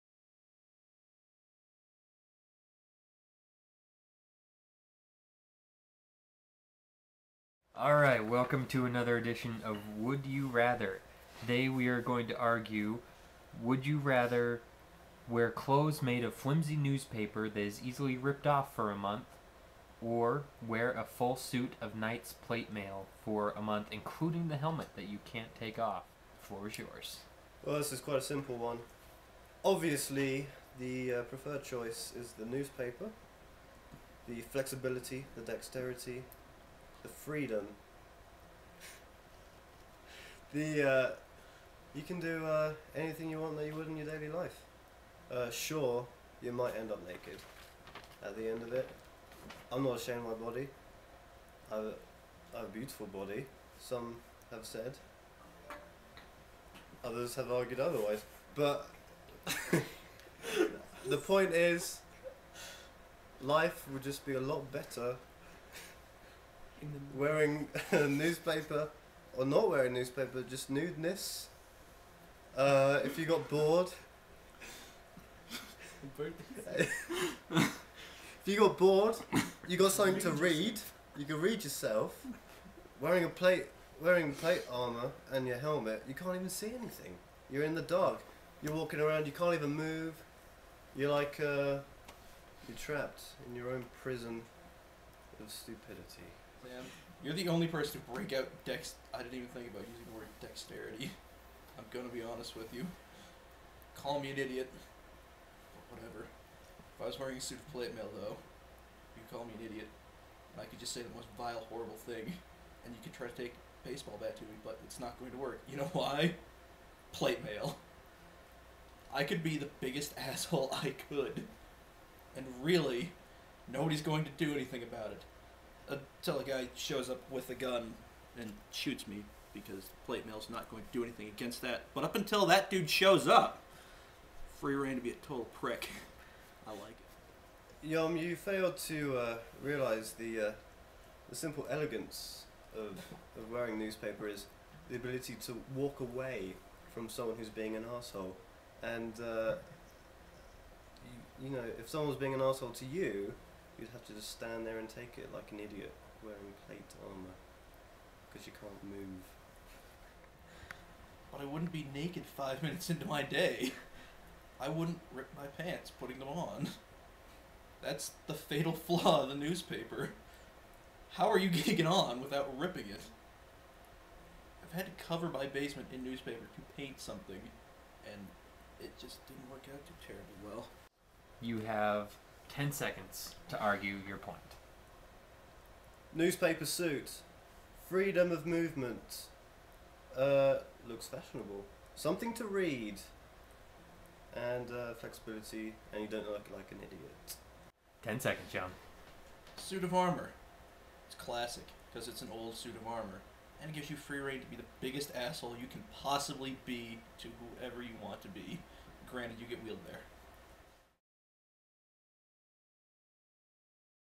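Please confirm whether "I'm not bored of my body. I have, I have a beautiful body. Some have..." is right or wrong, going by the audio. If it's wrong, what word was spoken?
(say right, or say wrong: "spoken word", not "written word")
wrong: "ashamed", not "bored".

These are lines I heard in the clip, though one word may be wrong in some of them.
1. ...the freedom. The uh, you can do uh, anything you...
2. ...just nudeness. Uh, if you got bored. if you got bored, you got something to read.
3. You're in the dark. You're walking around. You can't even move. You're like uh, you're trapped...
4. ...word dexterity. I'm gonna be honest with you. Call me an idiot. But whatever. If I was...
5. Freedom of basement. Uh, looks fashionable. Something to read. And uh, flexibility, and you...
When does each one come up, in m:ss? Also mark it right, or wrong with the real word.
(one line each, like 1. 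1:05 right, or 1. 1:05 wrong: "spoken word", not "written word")
1. 0:37 right
2. 1:10 right
3. 1:27 right
4. 1:40 right
5. 3:07 wrong: "movement", not "basement".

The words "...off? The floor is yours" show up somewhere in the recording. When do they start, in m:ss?
0:25.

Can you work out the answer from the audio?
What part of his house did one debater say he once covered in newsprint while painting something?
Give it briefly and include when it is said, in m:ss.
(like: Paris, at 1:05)
basement, at 2:55.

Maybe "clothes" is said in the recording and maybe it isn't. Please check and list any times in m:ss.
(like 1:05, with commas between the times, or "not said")
0:15.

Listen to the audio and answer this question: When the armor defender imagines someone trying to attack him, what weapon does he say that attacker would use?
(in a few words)
baseball bat.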